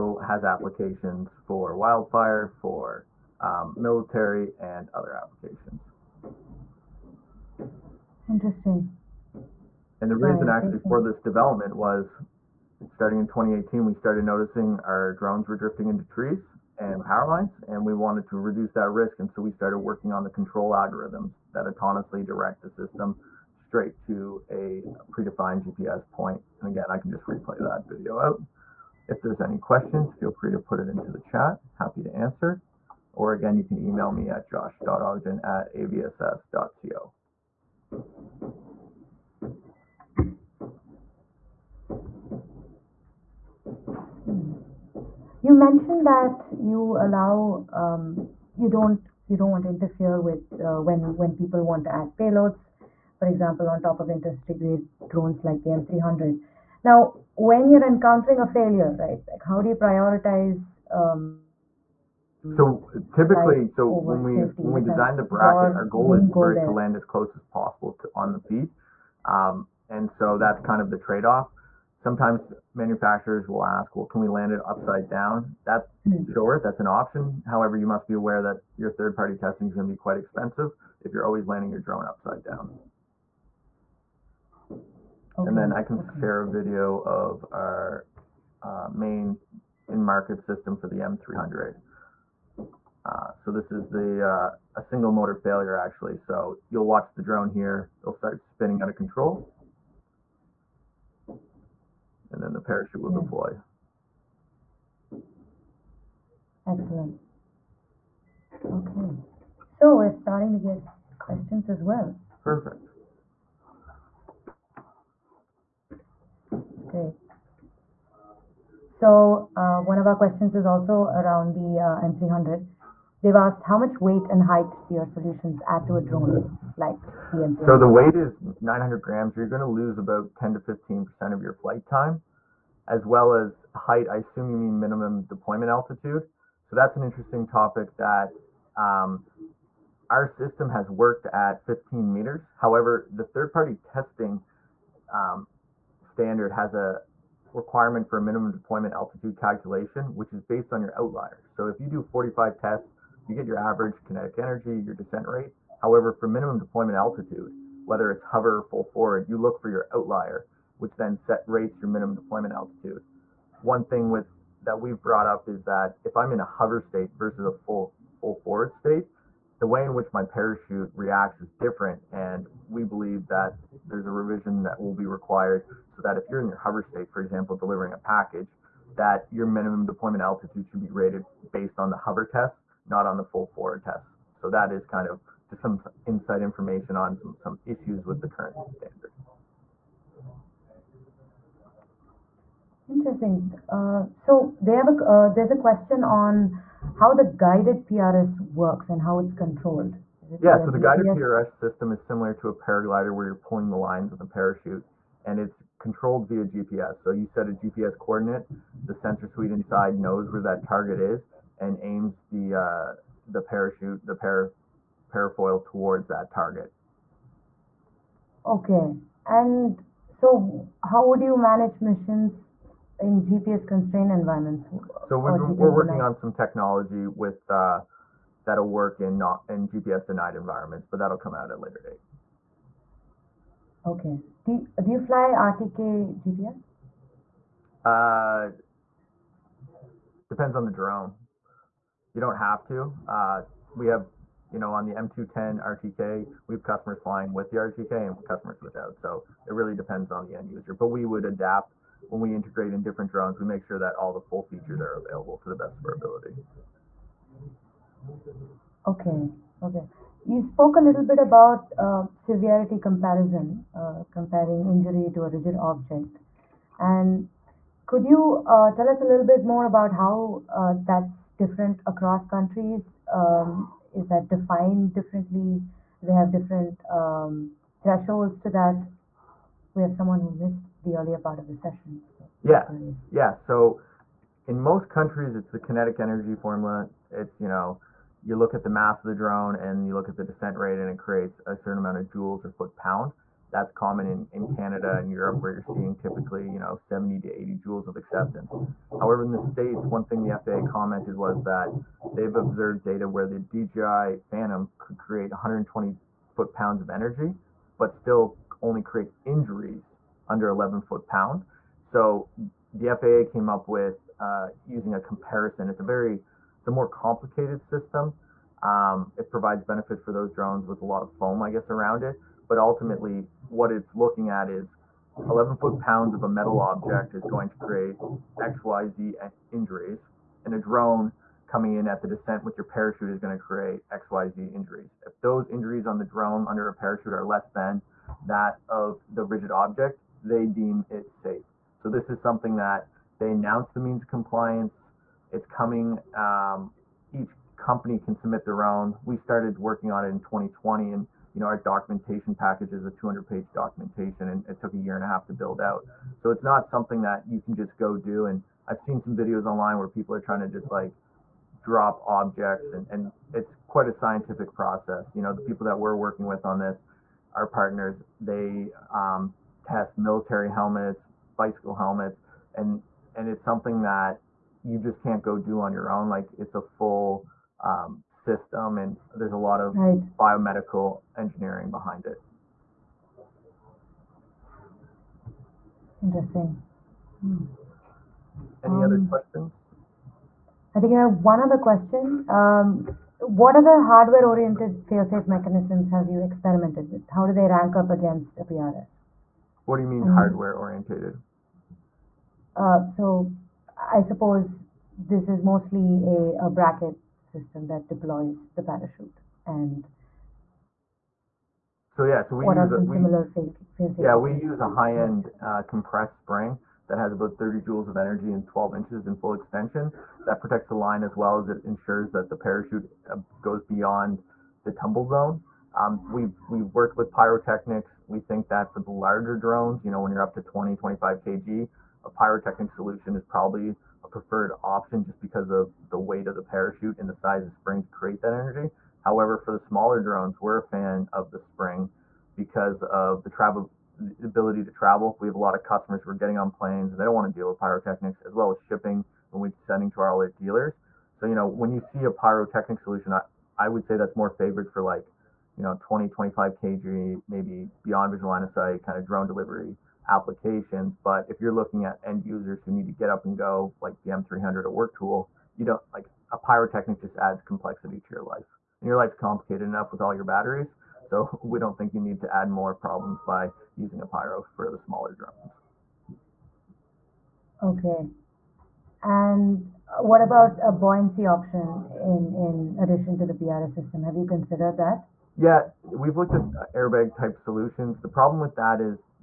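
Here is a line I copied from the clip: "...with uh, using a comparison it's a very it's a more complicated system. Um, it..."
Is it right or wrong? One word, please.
right.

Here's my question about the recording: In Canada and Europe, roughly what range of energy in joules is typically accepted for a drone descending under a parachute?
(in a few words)
70 to 80 joules.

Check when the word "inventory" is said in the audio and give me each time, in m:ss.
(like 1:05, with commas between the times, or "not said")
not said.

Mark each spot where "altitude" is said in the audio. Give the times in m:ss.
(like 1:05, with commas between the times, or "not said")
2:15, 2:28, 2:36, 2:42, 3:00.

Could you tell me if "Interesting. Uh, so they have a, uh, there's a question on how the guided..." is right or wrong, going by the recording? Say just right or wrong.
right.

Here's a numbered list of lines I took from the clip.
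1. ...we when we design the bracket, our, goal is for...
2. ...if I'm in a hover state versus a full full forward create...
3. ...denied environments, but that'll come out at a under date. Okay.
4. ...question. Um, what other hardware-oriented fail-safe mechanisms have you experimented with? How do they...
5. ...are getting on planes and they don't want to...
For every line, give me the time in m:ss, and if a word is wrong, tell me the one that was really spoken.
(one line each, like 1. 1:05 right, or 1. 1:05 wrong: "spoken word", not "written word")
1. 1:04 right
2. 2:46 wrong: "state", not "create"
3. 3:50 wrong: "later", not "under"
4. 6:31 right
5. 7:26 right.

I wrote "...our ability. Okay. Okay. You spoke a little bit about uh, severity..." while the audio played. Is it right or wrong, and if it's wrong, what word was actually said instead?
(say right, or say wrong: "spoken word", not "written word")
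right.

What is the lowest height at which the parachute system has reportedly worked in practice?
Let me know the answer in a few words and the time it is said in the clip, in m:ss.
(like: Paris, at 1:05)
15 meters, at 2:21.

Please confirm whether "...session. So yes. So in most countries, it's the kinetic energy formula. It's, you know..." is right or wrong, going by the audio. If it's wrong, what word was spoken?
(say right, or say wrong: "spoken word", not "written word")
right.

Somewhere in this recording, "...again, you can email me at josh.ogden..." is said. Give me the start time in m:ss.
0:33.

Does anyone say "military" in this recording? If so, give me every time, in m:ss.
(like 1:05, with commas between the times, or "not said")
0:03, 6:09.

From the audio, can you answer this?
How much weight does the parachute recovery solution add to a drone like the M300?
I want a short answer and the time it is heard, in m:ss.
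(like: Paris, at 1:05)
900 grams, at 2:08.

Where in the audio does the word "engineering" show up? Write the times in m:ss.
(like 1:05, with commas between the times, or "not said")
6:21.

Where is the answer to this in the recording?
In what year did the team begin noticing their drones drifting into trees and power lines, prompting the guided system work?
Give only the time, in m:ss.
0:13.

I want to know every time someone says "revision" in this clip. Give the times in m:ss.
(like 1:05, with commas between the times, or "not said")
2:54.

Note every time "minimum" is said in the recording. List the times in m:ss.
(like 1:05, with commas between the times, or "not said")
2:14, 2:28, 2:36, 2:41, 2:59.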